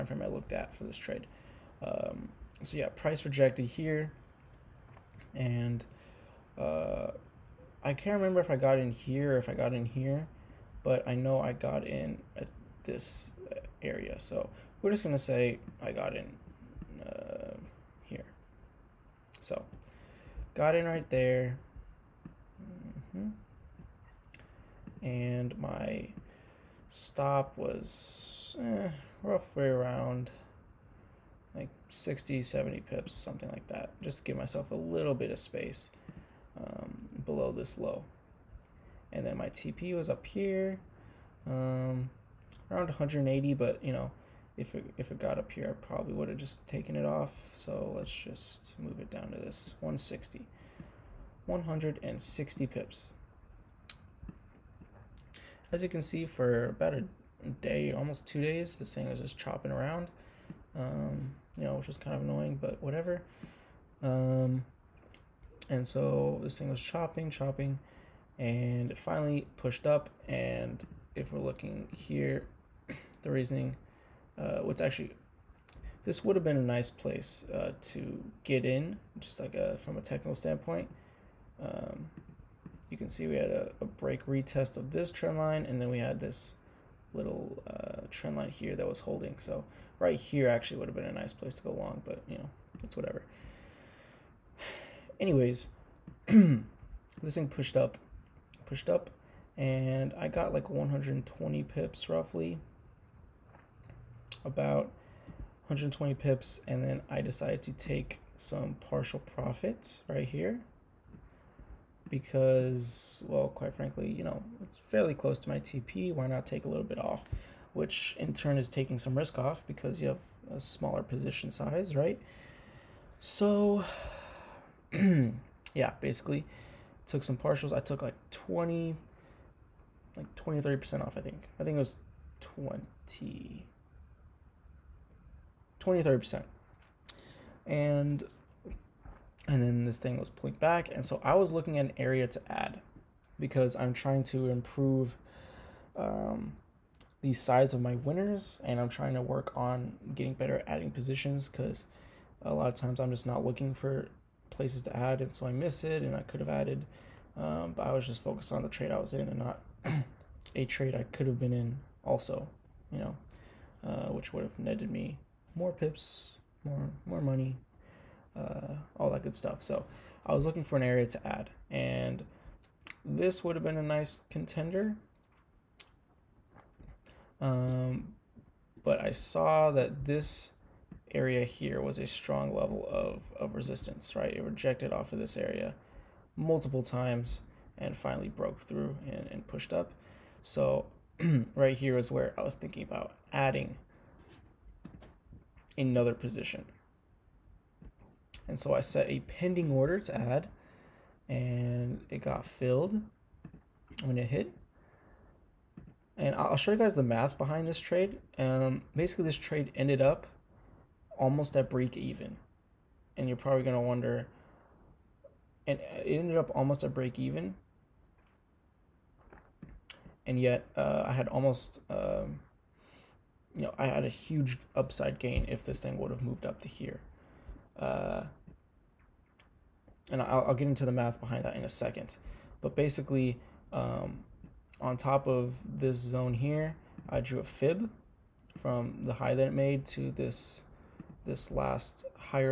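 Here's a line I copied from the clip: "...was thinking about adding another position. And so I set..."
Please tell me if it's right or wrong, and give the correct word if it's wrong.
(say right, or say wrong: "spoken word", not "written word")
right.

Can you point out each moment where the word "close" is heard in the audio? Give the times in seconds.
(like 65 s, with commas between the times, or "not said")
115 s.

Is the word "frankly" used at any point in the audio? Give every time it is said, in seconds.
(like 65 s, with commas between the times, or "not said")
113 s.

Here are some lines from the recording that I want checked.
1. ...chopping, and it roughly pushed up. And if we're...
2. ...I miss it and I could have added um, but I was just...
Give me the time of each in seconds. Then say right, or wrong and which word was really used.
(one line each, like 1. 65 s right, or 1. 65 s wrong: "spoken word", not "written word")
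1. 67 s wrong: "finally", not "roughly"
2. 155 s right.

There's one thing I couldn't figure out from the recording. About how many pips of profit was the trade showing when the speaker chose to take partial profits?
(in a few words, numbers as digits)
120 pips.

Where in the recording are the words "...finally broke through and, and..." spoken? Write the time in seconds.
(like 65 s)
187 s.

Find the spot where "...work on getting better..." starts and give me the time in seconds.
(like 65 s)
149 s.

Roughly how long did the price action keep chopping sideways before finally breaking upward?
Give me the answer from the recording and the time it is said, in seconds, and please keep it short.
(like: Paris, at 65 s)
almost two days, at 57 s.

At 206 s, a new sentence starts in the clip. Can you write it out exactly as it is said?
And I'll show you guys the math behind this trade.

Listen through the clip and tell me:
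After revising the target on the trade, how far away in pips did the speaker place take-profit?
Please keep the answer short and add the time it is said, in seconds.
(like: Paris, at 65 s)
160 pips, at 51 s.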